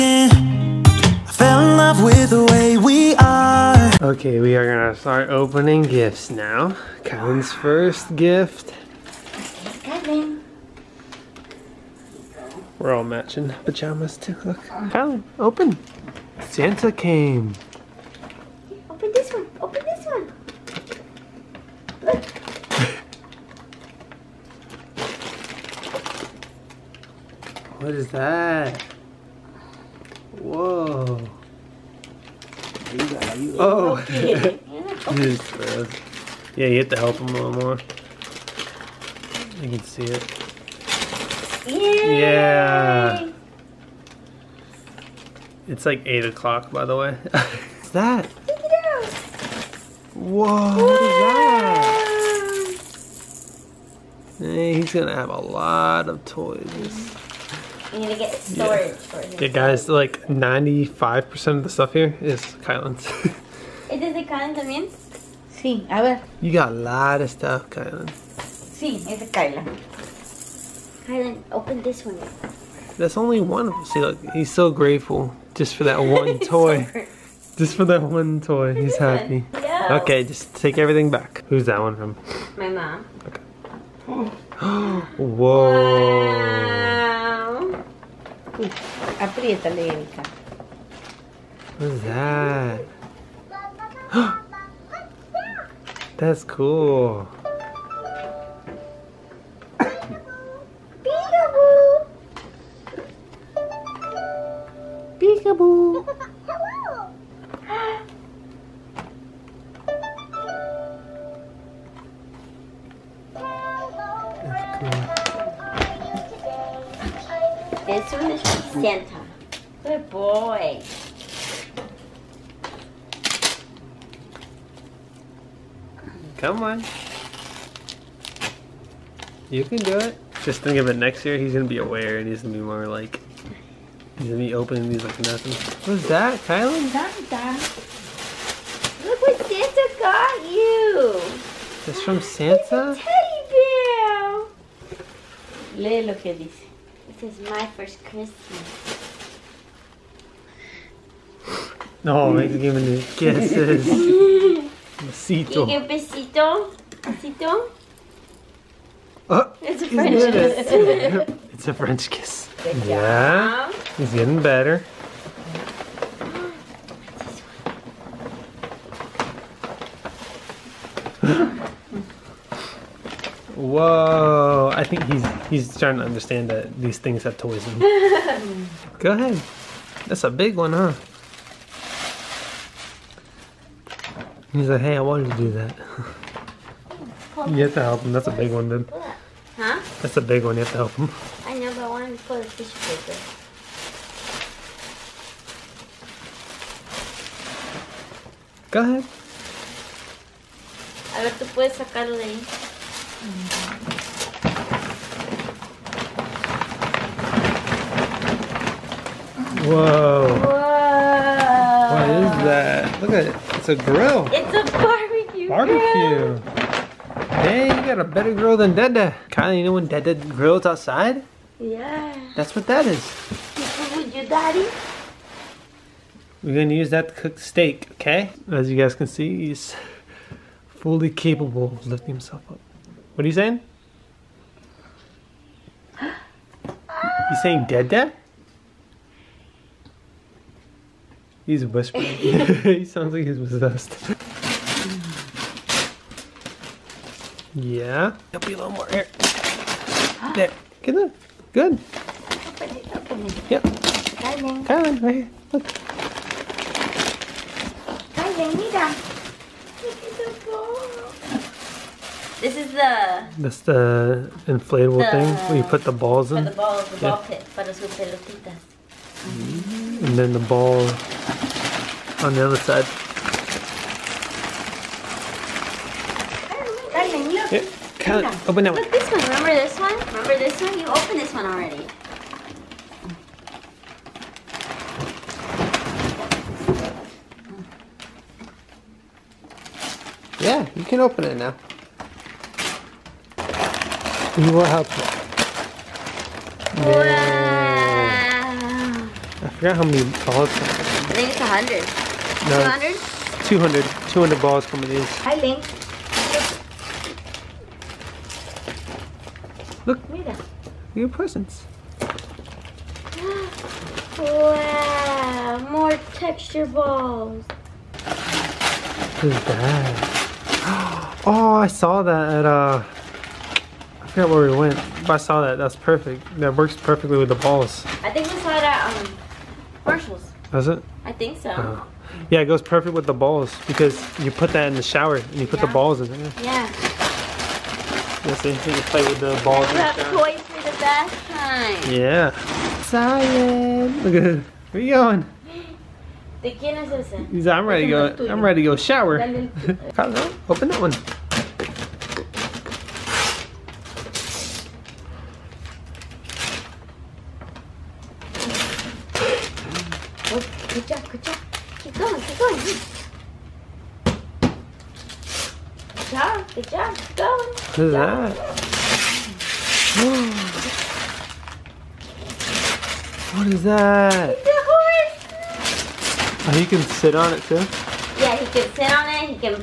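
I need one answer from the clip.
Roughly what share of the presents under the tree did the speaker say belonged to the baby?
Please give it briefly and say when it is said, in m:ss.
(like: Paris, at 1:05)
95%, at 1:00.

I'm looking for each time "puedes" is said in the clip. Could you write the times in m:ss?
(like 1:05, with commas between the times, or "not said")
3:21.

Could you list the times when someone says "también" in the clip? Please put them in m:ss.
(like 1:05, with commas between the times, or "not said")
1:04.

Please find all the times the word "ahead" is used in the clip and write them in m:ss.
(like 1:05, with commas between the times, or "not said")
2:59, 3:18.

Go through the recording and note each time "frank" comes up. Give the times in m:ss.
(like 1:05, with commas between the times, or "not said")
not said.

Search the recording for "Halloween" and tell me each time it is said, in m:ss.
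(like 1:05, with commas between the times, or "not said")
not said.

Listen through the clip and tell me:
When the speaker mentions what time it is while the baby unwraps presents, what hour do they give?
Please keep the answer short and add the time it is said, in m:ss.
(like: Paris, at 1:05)
8 o'clock, at 0:46.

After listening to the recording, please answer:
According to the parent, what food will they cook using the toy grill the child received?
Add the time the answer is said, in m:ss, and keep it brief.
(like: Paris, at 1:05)
steak, at 3:47.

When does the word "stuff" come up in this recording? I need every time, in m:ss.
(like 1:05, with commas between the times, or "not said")
1:01, 1:07.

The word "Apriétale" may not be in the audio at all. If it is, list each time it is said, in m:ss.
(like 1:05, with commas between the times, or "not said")
1:29.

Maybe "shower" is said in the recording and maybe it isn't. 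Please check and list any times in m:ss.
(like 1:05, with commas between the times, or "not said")
5:34, 5:39, 5:48.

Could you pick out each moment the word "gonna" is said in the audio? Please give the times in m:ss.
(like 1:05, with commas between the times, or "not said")
0:04, 0:54, 3:46.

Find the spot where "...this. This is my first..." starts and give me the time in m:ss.
2:26.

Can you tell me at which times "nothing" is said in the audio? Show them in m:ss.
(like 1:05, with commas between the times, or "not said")
2:15.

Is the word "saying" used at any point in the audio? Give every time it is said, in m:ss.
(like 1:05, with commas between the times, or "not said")
3:53, 3:57.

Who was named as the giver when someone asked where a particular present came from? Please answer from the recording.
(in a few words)
My mom.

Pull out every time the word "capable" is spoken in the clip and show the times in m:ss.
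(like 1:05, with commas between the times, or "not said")
3:51.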